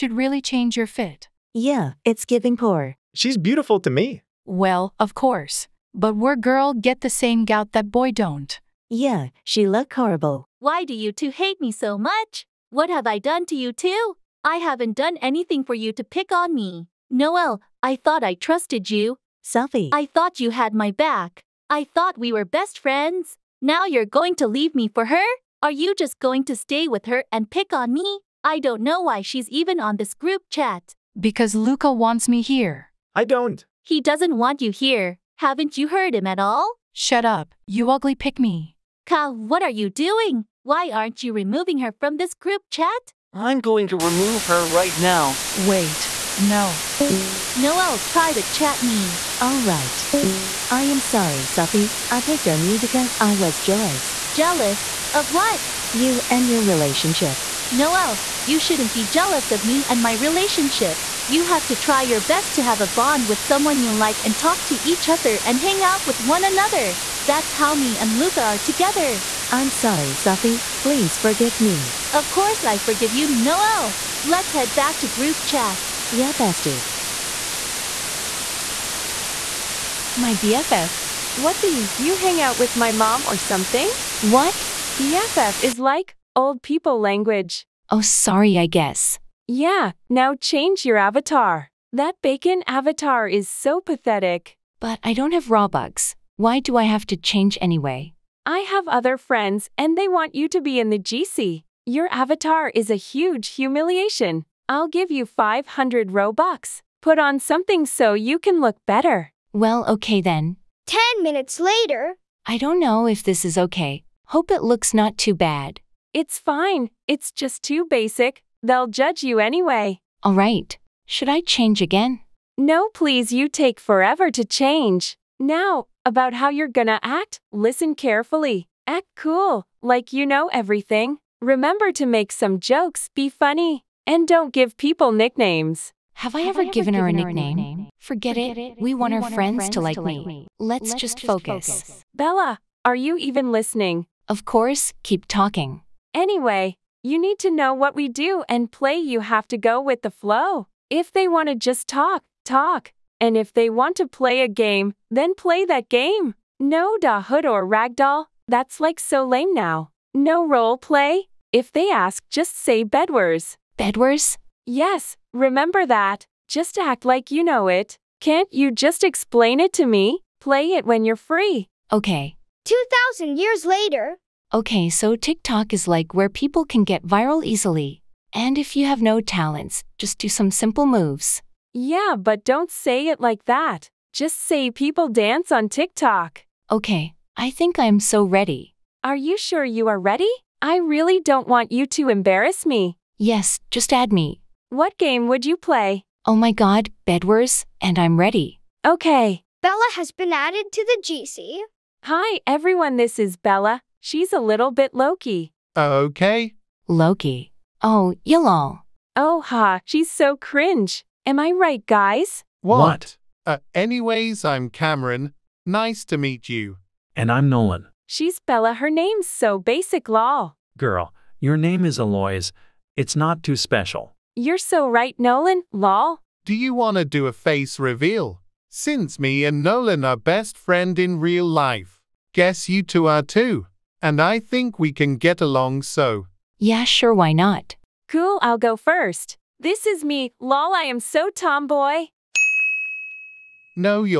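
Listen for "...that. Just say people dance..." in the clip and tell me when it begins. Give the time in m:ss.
3:03.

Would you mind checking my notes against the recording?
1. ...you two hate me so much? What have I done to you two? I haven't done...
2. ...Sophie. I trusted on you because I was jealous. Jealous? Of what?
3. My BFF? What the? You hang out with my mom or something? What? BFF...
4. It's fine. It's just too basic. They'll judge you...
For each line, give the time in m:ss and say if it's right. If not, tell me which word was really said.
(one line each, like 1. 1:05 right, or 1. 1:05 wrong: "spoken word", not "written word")
1. 0:10 right
2. 0:51 wrong: "picked", not "trusted"
3. 1:20 right
4. 1:56 right.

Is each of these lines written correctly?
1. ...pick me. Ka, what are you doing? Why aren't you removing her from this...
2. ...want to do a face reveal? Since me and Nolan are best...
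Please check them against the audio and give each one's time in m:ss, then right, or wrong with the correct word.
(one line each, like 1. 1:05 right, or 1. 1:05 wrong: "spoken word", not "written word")
1. 0:38 right
2. 3:46 right.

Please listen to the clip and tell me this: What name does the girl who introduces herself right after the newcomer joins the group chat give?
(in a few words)
Cameron.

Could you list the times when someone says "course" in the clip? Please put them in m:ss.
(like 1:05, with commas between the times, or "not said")
0:05, 1:12, 2:24.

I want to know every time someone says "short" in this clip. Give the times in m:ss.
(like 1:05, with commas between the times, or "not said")
not said.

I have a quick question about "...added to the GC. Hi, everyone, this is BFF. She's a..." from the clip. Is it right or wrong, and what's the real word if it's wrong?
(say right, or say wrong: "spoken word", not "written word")
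wrong: "Bella", not "BFF".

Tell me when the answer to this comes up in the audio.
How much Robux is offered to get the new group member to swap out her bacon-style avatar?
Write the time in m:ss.
1:45.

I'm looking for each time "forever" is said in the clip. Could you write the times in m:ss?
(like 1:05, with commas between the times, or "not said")
2:03.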